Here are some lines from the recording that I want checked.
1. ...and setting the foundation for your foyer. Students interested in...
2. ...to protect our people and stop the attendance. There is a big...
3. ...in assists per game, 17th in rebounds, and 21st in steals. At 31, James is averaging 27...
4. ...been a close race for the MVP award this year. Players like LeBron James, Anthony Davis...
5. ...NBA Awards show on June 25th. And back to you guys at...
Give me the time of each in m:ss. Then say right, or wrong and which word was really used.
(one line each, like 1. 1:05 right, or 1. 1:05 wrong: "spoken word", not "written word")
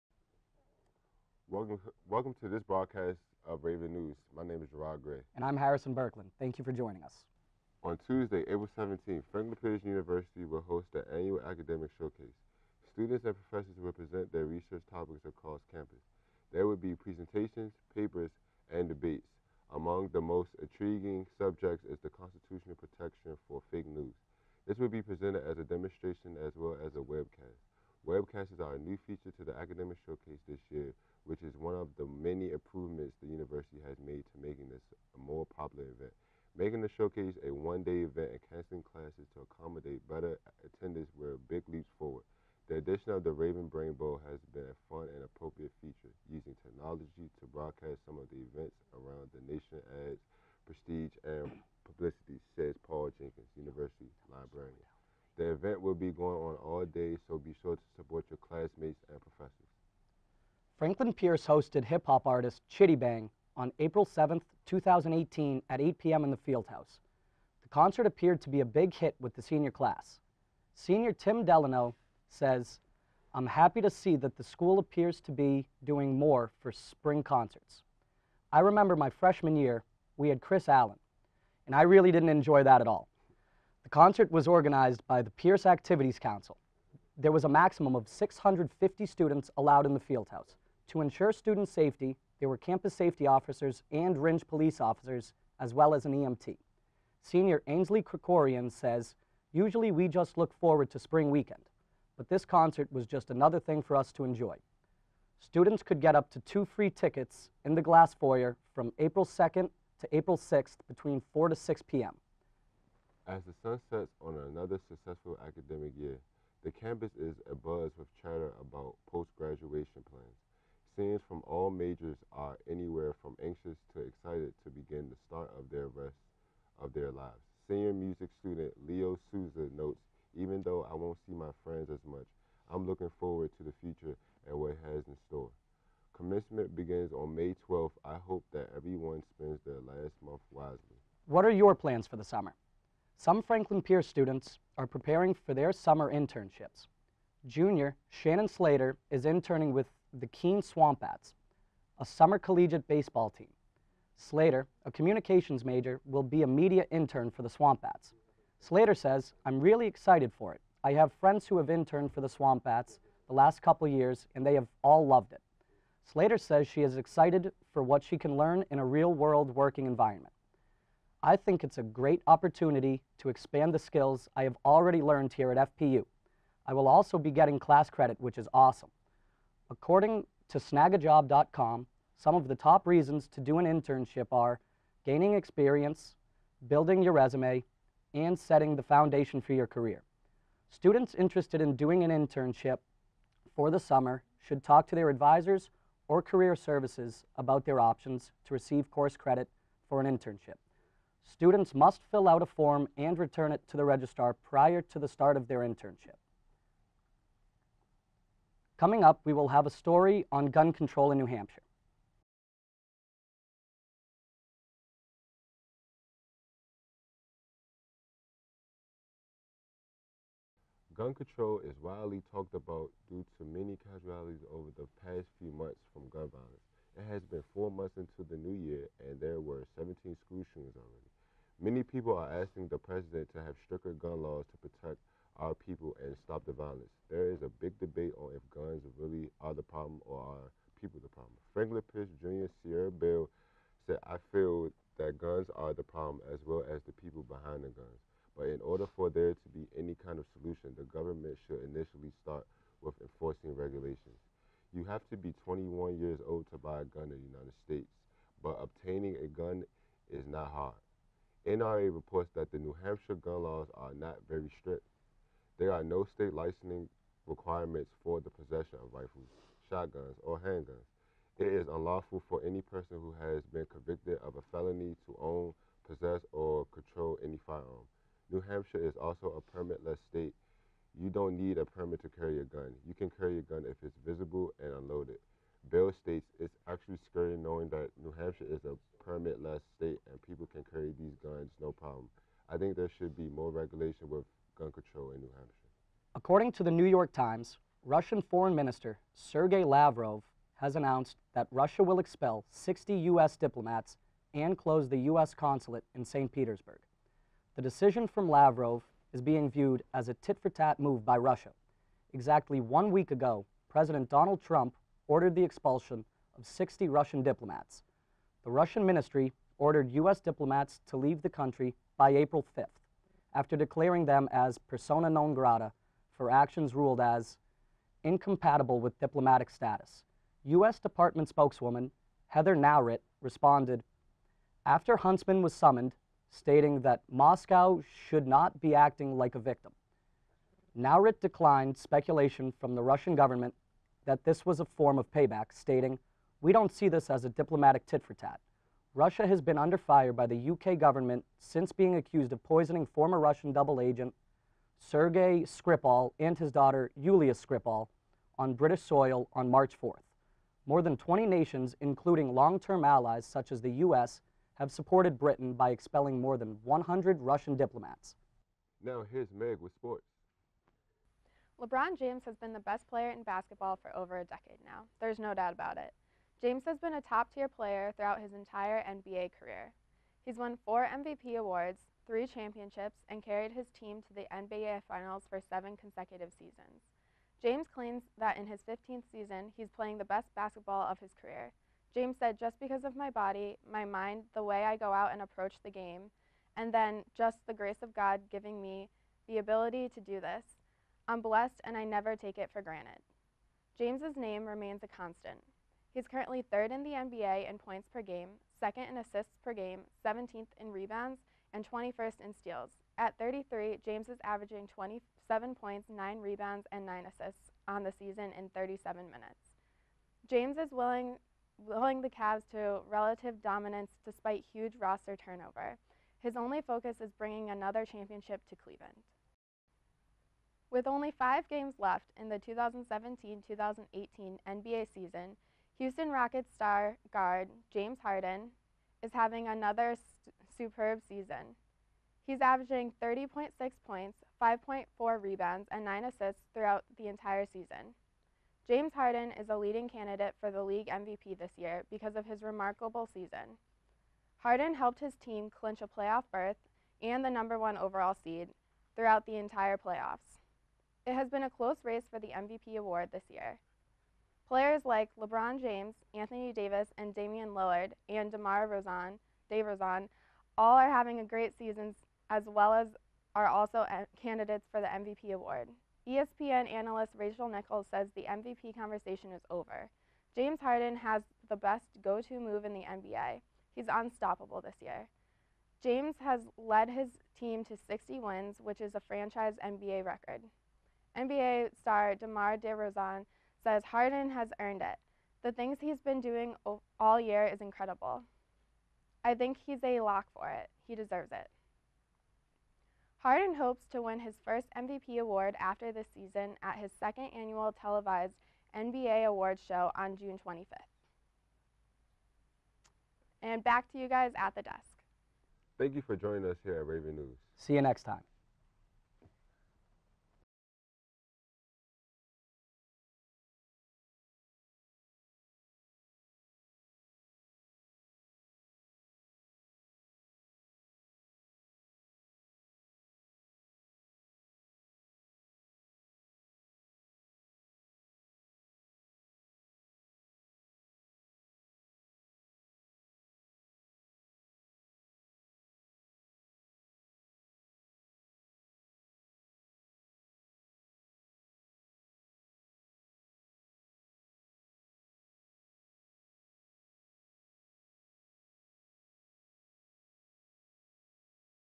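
1. 3:08 wrong: "career", not "foyer"
2. 3:54 wrong: "violence", not "attendance"
3. 6:48 wrong: "33", not "31"
4. 7:41 right
5. 8:28 right.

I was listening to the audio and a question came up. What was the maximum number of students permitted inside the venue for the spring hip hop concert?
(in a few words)
650.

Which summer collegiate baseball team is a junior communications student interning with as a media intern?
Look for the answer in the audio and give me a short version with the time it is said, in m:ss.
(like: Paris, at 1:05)
Keene Swamp Bats, at 2:30.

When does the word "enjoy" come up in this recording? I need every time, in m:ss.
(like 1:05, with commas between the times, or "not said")
1:22, 1:44.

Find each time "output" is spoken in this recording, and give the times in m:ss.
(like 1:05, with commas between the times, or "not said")
not said.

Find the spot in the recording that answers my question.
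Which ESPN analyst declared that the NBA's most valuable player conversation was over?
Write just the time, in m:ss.
7:57.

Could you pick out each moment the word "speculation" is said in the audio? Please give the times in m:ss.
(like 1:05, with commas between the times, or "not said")
5:41.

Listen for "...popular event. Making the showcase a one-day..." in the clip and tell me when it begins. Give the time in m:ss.
0:35.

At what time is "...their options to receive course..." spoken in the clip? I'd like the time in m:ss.
3:17.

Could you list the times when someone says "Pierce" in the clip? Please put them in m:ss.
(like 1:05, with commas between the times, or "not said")
0:09, 1:01, 1:25, 2:23, 4:01.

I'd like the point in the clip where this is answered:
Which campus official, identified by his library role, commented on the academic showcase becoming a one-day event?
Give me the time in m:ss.
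0:52.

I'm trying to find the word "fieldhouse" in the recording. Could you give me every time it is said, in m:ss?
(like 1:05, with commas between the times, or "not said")
1:06, 1:29.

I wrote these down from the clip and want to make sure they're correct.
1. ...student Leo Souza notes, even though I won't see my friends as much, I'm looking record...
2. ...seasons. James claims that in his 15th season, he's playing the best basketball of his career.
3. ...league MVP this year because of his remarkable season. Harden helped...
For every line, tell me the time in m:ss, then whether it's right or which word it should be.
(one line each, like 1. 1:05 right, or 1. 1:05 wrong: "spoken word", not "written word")
1. 2:08 wrong: "forward", not "record"
2. 6:26 right
3. 7:30 right.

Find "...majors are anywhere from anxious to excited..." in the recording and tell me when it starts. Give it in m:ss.
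2:01.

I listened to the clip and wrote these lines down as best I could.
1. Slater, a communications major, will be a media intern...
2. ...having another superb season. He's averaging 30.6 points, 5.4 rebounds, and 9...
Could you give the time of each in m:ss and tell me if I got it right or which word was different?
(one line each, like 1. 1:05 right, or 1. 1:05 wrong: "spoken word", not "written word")
1. 2:34 right
2. 7:19 right.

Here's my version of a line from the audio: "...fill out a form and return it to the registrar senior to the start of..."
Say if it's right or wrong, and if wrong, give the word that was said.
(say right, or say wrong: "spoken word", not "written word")
wrong: "prior", not "senior".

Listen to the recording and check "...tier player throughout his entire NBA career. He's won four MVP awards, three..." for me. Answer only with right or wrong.
right.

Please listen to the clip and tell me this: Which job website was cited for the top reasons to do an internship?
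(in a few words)
snagajob.com.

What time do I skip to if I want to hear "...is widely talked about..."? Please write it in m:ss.
3:41.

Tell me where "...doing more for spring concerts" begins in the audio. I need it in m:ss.
1:15.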